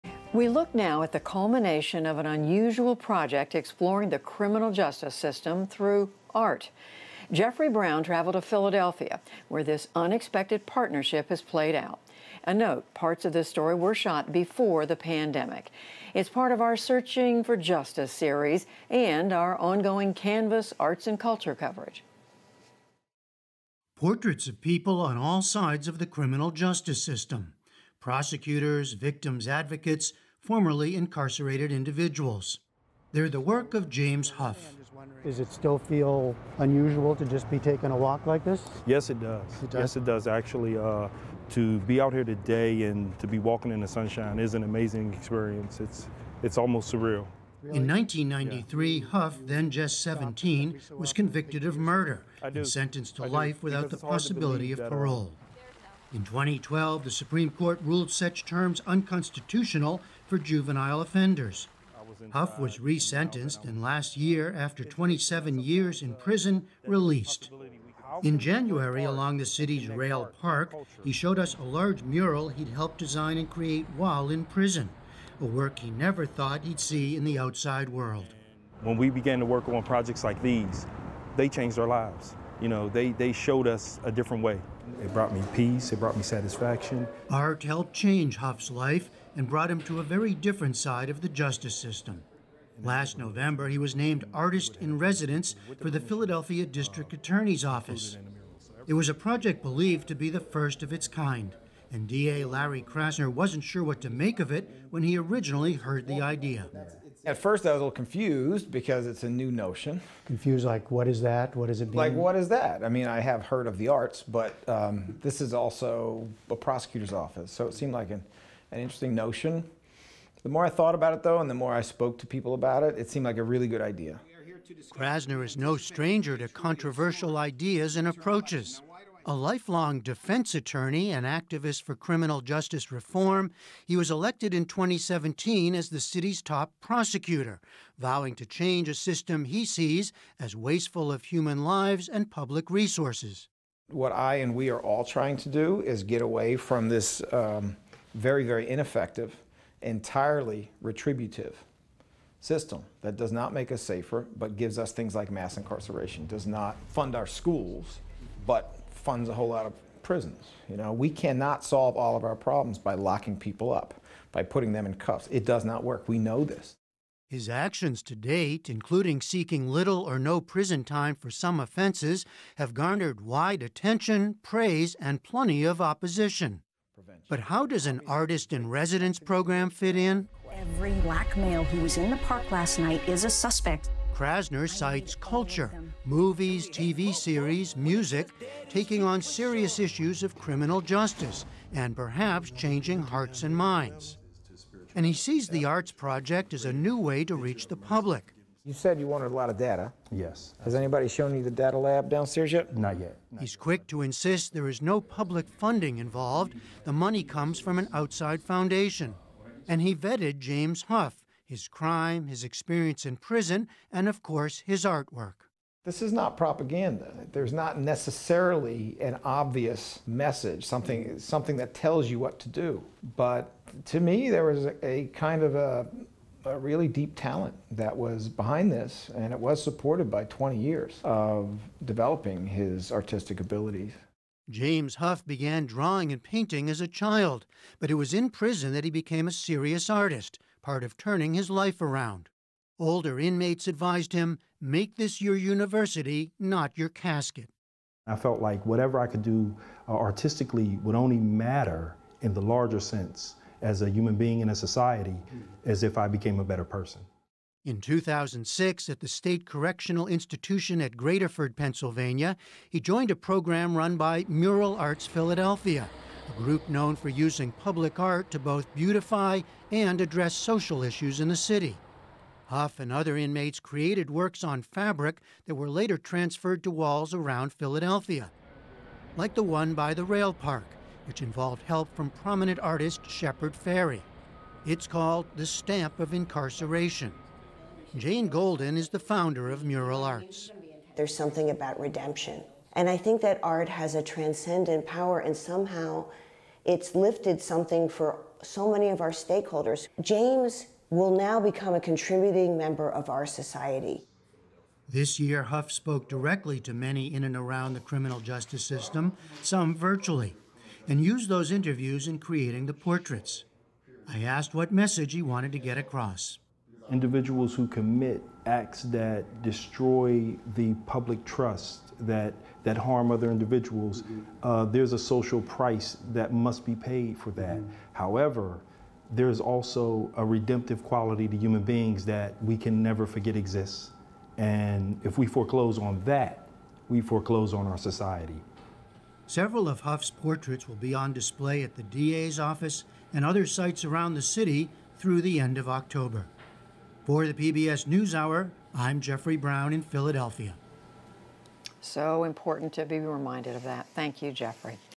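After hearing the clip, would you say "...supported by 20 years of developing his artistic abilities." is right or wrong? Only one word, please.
right.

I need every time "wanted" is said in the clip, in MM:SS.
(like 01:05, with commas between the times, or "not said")
03:19, 05:15.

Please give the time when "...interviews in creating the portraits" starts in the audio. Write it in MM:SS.
05:11.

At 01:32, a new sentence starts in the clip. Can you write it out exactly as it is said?
Last November, he was named Artist in Residence for the Philadelphia District Attorney's Office.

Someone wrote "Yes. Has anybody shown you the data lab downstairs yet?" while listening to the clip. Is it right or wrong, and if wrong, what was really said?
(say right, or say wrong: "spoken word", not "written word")
right.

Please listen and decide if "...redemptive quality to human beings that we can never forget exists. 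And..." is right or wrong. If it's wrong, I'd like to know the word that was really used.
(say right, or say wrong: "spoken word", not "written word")
right.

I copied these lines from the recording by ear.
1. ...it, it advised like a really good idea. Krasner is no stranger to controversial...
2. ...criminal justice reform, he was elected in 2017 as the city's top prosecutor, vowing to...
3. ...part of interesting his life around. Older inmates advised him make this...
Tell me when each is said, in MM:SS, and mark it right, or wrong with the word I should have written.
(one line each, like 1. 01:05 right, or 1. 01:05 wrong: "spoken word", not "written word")
1. 02:02 wrong: "seemed", not "advised"
2. 02:11 right
3. 04:00 wrong: "turning", not "interesting".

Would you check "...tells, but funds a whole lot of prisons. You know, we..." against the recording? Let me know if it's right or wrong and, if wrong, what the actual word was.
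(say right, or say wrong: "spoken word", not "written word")
wrong: "schools", not "tells".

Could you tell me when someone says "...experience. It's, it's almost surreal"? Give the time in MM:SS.
00:45.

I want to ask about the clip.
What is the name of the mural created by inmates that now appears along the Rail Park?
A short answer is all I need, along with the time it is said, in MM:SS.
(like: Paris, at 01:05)
Stamp of Incarceration, at 04:45.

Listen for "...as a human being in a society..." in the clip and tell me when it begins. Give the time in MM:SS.
04:13.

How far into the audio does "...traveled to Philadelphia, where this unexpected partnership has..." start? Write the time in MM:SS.
00:08.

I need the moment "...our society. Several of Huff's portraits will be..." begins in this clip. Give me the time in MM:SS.
05:37.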